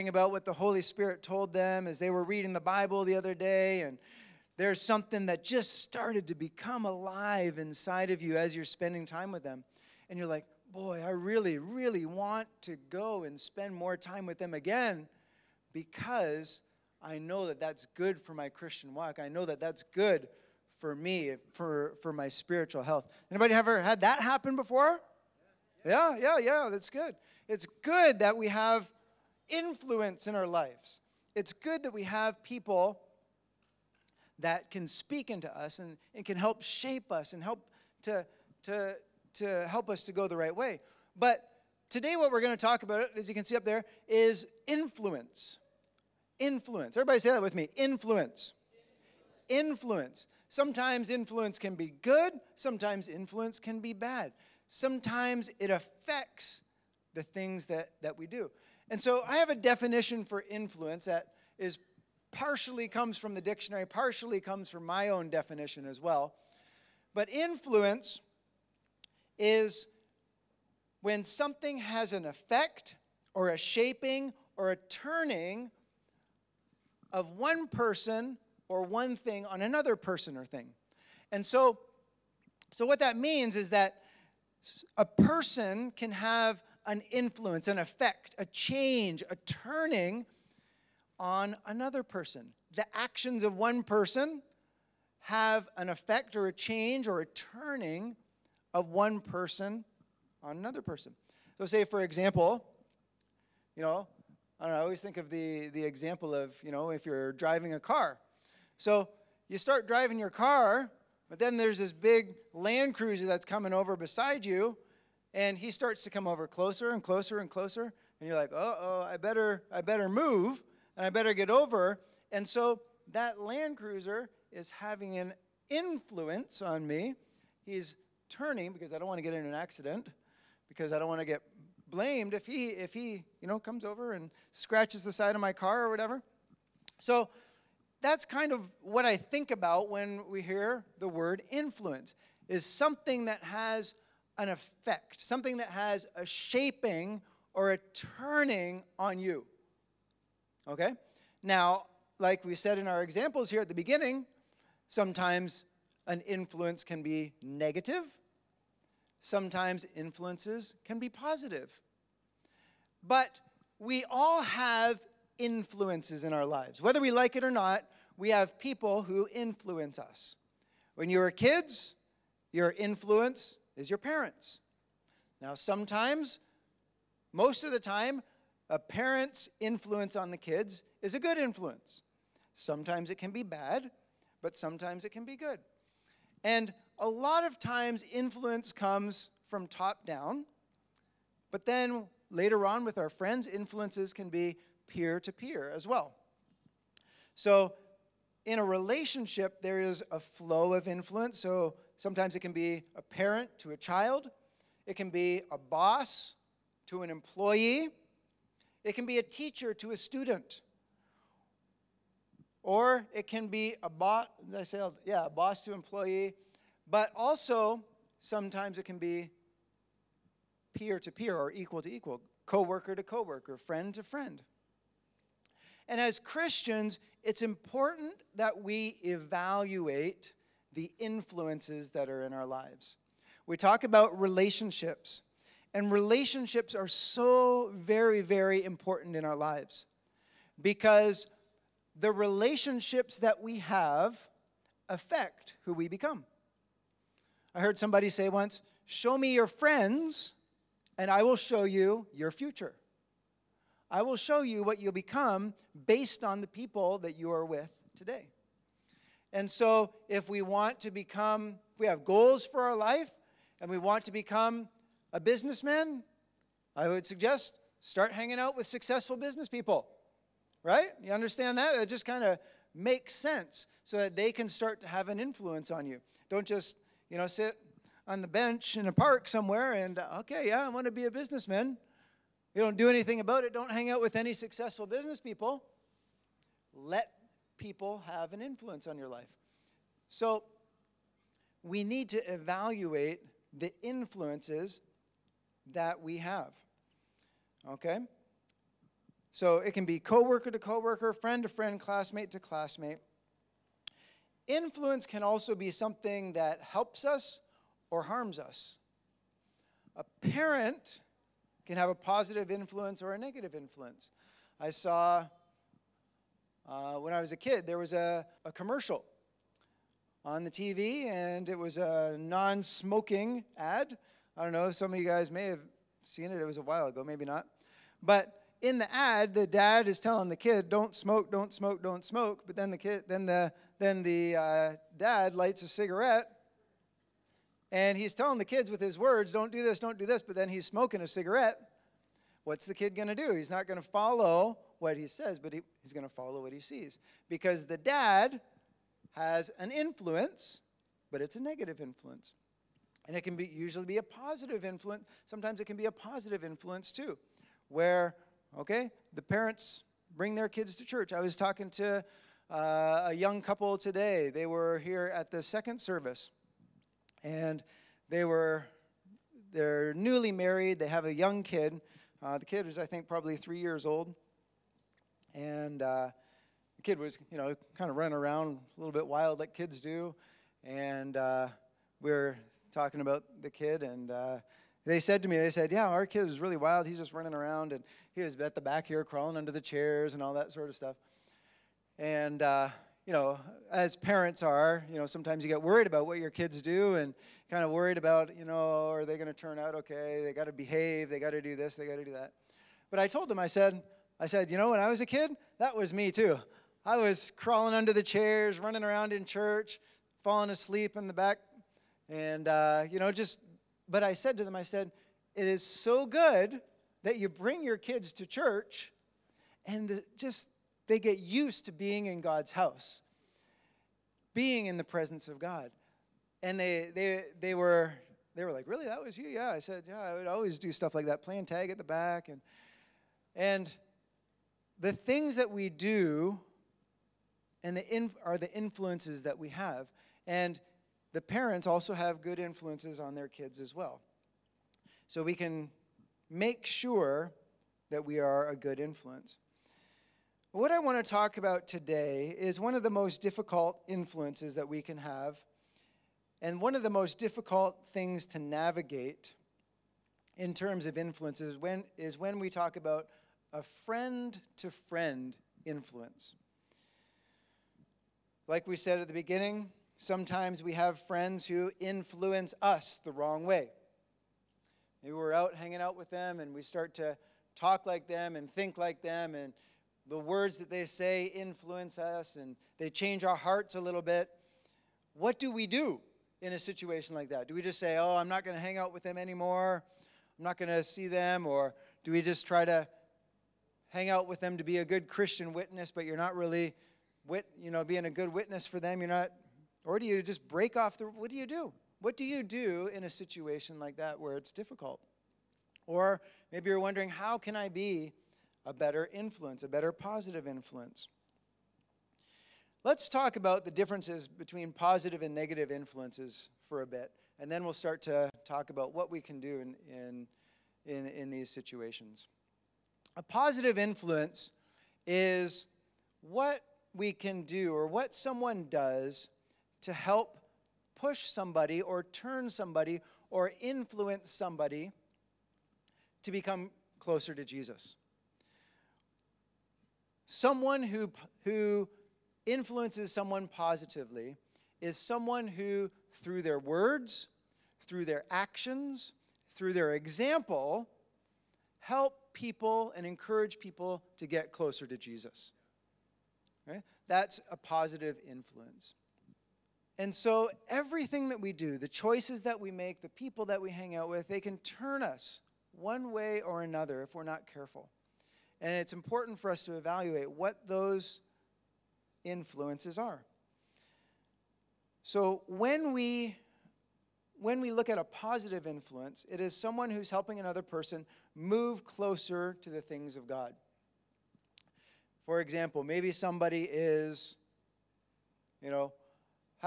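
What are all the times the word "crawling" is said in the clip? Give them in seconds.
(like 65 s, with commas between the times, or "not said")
389 s, 407 s.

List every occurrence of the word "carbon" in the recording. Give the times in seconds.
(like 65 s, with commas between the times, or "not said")
not said.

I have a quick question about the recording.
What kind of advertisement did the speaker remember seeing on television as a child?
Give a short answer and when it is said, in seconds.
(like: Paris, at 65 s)
non smoking ad, at 322 s.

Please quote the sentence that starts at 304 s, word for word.
Influence can also be something that helps us or harms us.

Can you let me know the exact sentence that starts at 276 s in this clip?
Don't just, you know, sit on the bench in a park somewhere and, okay, yeah, I want to be a businessman.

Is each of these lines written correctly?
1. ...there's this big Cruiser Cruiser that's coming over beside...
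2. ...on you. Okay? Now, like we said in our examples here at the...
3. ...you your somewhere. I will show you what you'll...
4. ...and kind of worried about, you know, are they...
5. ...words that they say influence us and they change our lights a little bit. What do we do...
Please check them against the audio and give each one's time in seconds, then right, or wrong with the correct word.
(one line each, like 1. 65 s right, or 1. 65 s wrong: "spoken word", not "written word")
1. 111 s wrong: "Land", not "Cruiser"
2. 148 s right
3. 251 s wrong: "future", not "somewhere"
4. 396 s right
5. 480 s wrong: "hearts", not "lights".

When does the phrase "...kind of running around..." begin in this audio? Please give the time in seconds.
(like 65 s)
377 s.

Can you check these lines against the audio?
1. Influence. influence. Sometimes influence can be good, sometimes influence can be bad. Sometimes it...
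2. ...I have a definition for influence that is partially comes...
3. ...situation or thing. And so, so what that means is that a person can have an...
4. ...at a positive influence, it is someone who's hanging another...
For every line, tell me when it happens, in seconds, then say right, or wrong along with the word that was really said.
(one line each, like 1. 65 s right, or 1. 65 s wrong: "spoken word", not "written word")
1. 49 s right
2. 59 s right
3. 79 s wrong: "person", not "situation"
4. 577 s wrong: "helping", not "hanging".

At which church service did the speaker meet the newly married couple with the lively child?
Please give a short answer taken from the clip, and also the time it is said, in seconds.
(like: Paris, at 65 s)
second service, at 365 s.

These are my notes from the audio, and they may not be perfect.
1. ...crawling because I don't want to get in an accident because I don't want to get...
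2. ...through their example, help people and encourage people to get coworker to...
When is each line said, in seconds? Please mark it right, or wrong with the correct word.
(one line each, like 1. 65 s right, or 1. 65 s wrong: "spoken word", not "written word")
1. 128 s wrong: "turning", not "crawling"
2. 549 s wrong: "closer", not "coworker".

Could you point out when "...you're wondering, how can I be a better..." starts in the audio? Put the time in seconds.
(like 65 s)
506 s.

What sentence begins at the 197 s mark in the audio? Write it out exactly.
So, in a relationship, there is a flow of influence.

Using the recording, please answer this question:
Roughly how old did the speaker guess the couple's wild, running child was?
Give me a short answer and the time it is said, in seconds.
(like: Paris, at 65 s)
3 years old, at 373 s.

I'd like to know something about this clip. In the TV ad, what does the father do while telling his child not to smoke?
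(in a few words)
lights a cigarette.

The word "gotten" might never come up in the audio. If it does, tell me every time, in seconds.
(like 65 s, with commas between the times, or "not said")
not said.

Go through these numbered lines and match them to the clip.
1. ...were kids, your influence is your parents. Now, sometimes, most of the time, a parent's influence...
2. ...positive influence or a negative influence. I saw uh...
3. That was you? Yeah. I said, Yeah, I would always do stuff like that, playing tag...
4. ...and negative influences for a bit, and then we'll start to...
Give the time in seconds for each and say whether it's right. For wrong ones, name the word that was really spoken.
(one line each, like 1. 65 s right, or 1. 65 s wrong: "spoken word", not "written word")
1. 171 s right
2. 311 s right
3. 428 s right
4. 515 s right.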